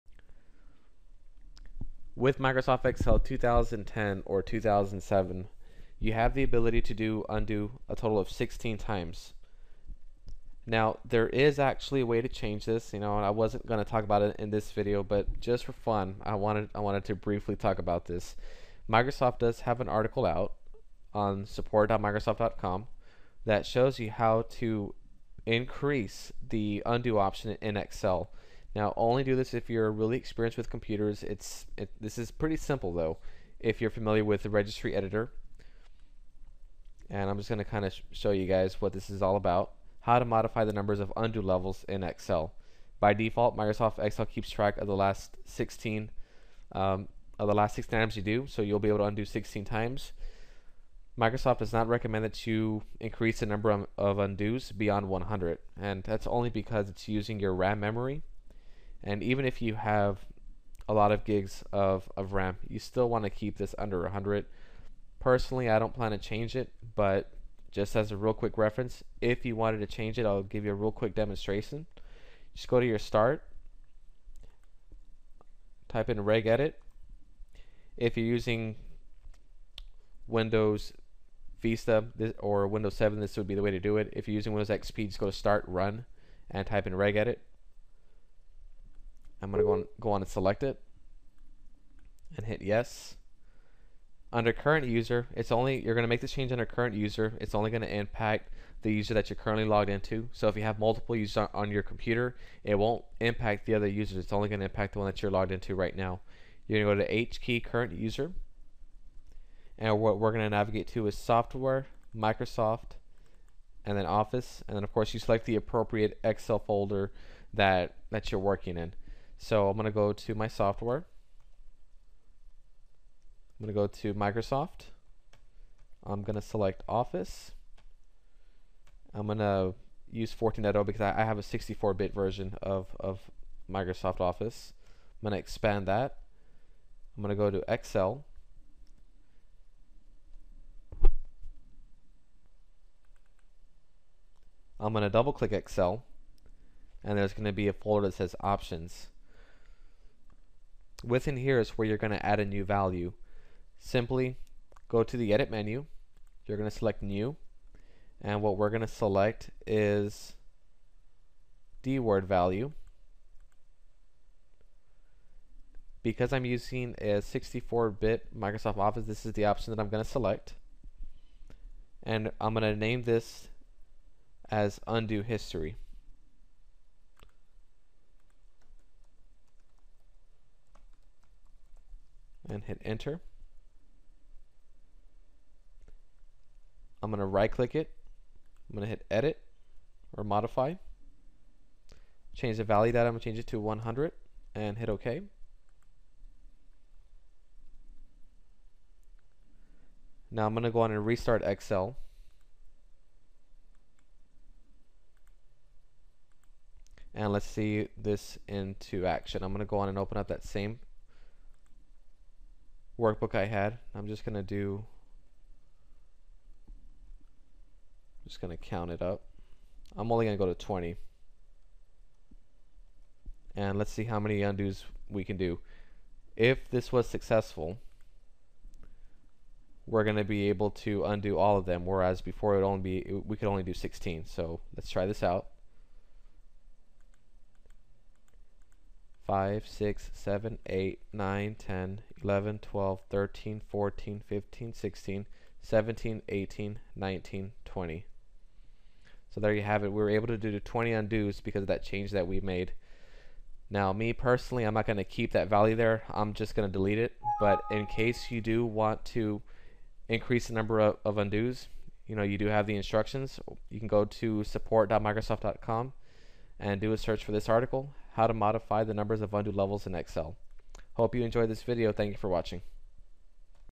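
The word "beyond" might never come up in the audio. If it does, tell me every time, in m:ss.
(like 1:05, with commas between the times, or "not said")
0:54.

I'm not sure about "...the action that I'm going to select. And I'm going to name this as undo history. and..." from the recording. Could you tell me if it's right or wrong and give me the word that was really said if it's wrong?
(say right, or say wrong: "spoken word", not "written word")
wrong: "option", not "action".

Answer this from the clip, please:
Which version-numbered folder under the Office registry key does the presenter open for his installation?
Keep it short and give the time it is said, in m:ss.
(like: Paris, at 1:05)
14.0, at 2:10.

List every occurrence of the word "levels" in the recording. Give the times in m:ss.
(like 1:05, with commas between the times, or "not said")
0:41, 4:29.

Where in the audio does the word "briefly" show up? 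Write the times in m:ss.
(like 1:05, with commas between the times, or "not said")
0:17.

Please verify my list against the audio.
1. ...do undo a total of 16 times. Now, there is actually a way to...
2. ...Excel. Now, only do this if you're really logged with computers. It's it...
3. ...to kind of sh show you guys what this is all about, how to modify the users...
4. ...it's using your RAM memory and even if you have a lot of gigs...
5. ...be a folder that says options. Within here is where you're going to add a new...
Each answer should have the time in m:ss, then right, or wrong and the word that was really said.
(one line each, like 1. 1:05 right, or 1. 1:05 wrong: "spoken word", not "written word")
1. 0:06 right
2. 0:27 wrong: "experienced", not "logged"
3. 0:37 wrong: "numbers", not "users"
4. 0:56 right
5. 2:27 right.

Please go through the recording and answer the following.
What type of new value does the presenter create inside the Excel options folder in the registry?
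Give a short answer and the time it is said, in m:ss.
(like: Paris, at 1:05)
DWORD value, at 2:41.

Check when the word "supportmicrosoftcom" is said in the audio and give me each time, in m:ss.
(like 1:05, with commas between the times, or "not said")
0:21, 4:24.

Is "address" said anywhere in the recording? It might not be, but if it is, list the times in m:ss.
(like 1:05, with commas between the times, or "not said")
not said.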